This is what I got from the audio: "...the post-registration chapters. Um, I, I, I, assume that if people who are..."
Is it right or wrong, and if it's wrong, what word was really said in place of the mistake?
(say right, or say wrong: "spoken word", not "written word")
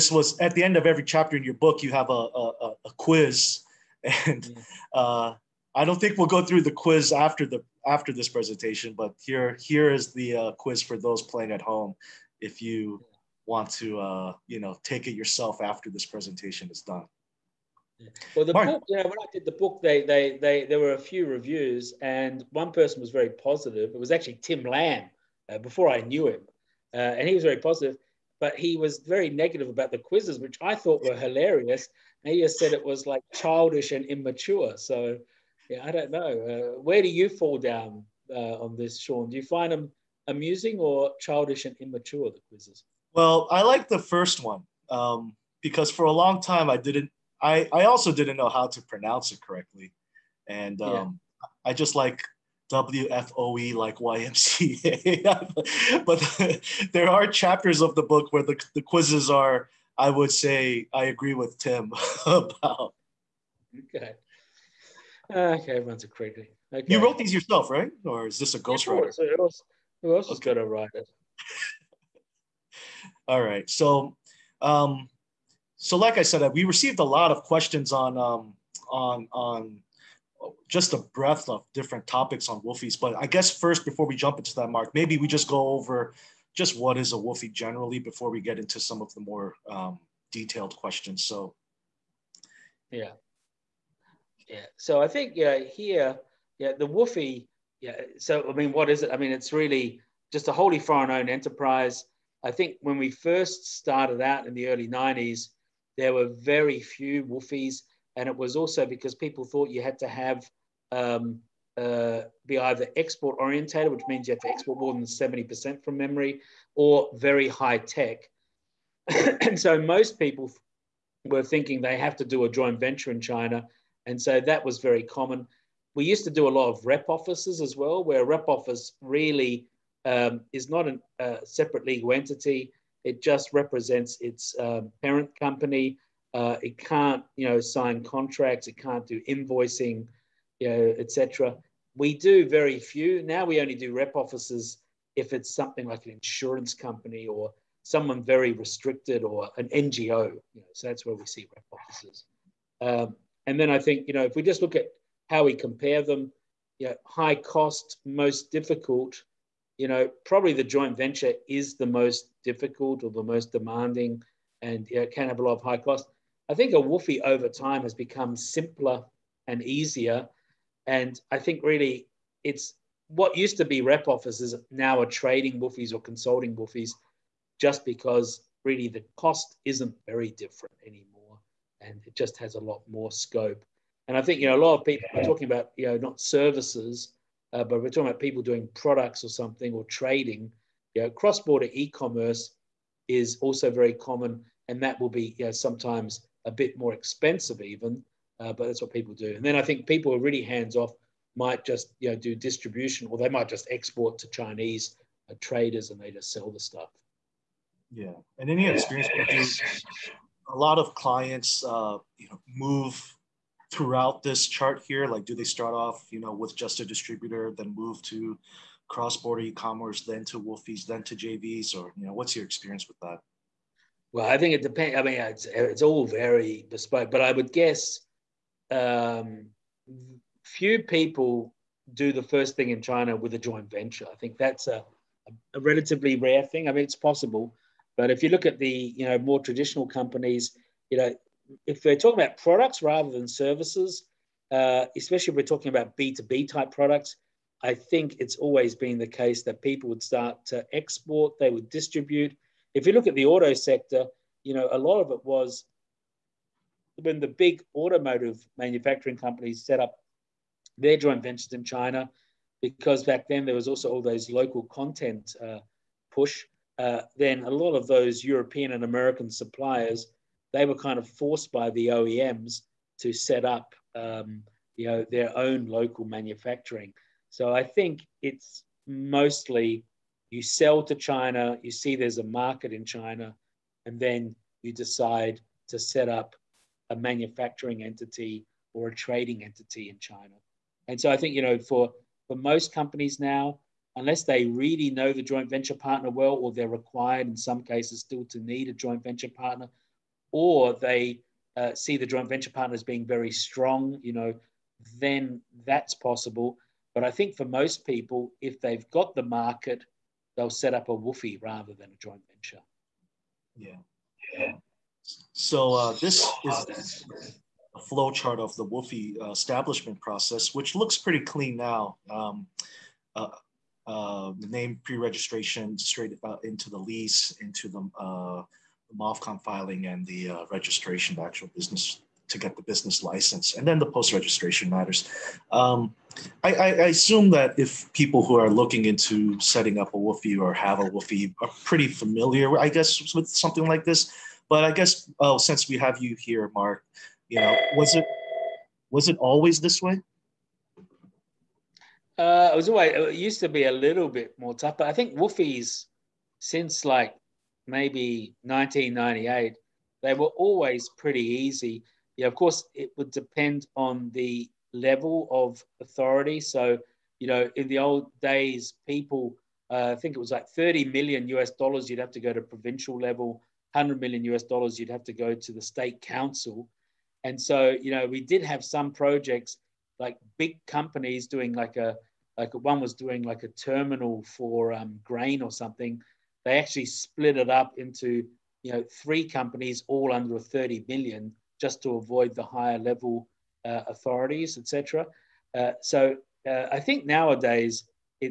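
wrong: "matters", not "chapters".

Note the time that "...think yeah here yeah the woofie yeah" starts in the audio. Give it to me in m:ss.
1:35.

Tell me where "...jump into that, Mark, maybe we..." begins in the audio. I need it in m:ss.
1:24.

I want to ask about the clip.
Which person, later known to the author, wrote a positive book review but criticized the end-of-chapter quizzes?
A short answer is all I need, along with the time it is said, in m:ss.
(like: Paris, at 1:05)
Tim Lamb, at 0:24.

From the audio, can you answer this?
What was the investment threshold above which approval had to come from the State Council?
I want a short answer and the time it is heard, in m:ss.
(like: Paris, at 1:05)
100 million US dollars, at 6:13.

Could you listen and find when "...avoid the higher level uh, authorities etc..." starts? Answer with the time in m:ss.
6:31.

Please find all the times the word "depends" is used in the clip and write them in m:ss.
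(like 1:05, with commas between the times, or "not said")
3:44, 6:03.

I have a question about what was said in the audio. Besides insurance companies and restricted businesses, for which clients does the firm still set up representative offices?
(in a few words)
NGO.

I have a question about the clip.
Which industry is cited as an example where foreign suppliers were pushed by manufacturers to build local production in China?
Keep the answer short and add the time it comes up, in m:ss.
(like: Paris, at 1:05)
auto sector, at 4:13.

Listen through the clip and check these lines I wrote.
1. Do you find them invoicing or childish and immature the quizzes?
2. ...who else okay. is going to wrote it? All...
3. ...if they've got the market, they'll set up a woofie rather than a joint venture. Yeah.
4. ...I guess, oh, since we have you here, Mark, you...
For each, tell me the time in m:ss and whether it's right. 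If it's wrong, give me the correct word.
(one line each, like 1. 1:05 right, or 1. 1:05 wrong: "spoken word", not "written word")
1. 0:39 wrong: "amusing", not "invoicing"
2. 1:10 wrong: "write", not "wrote"
3. 5:08 right
4. 5:44 right.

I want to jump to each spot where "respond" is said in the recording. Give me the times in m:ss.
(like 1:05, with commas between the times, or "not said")
not said.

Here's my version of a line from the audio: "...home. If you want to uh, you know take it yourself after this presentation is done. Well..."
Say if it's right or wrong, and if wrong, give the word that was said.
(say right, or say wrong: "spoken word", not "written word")
right.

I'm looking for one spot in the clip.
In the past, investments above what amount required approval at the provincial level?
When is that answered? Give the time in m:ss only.
6:10.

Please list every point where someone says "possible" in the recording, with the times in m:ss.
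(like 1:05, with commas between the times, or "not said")
3:56, 5:05.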